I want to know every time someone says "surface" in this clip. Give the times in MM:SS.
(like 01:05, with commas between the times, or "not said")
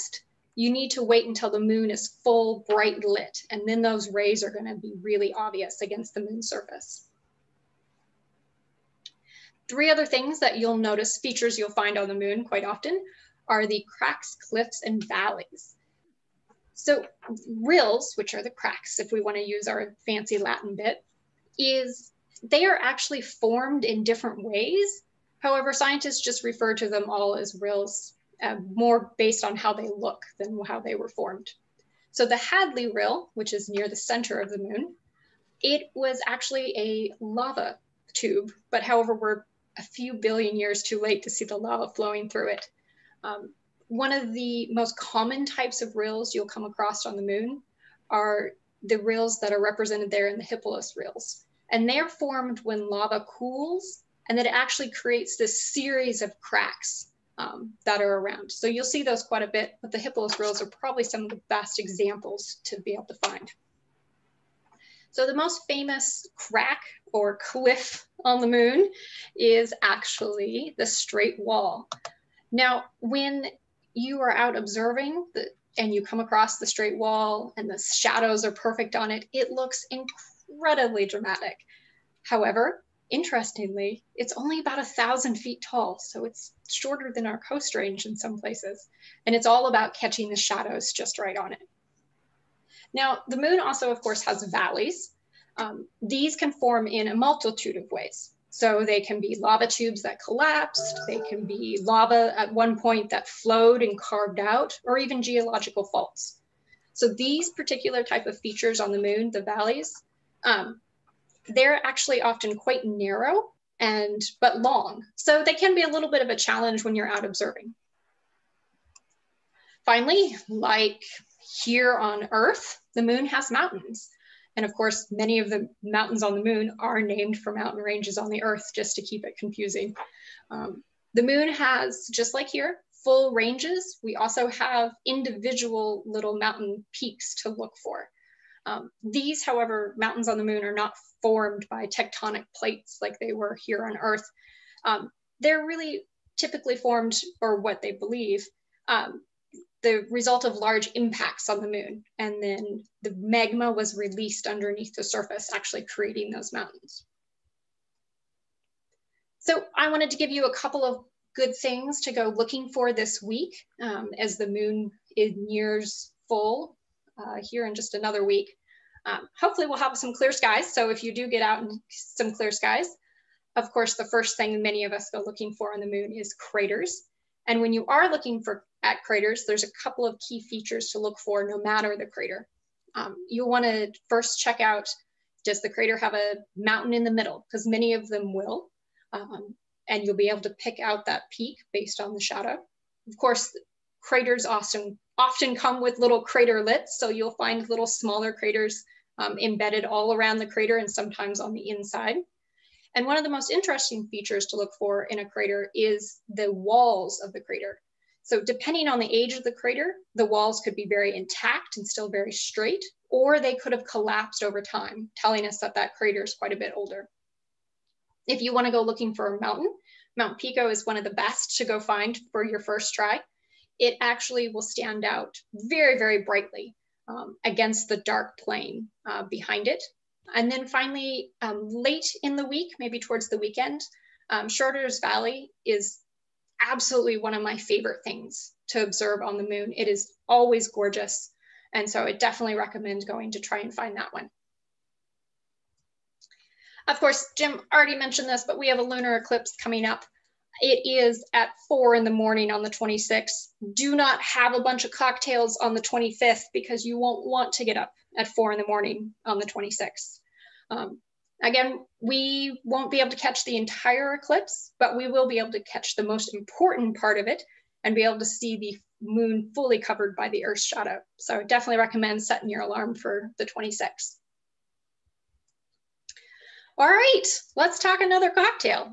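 00:06, 02:35.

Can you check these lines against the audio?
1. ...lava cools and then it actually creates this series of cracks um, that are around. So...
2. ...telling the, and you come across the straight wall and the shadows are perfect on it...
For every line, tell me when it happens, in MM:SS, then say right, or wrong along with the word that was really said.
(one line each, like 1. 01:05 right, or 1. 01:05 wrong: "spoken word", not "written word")
1. 00:52 right
2. 01:14 wrong: "observing", not "telling".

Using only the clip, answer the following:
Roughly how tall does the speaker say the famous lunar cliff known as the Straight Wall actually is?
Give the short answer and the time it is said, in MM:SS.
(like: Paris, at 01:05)
about 1,000 feet, at 01:24.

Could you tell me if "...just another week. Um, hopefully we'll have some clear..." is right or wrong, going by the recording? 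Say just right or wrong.
right.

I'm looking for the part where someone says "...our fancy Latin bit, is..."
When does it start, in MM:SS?
00:19.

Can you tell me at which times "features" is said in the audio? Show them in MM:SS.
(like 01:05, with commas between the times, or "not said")
00:11, 01:48, 03:00, 03:24.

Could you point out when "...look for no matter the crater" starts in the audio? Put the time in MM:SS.
03:00.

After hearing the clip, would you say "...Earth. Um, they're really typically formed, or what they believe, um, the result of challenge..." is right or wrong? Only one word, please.
wrong.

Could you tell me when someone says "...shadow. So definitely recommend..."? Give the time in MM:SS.
04:30.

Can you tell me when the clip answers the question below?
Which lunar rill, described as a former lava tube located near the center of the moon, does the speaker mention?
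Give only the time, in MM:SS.
00:32.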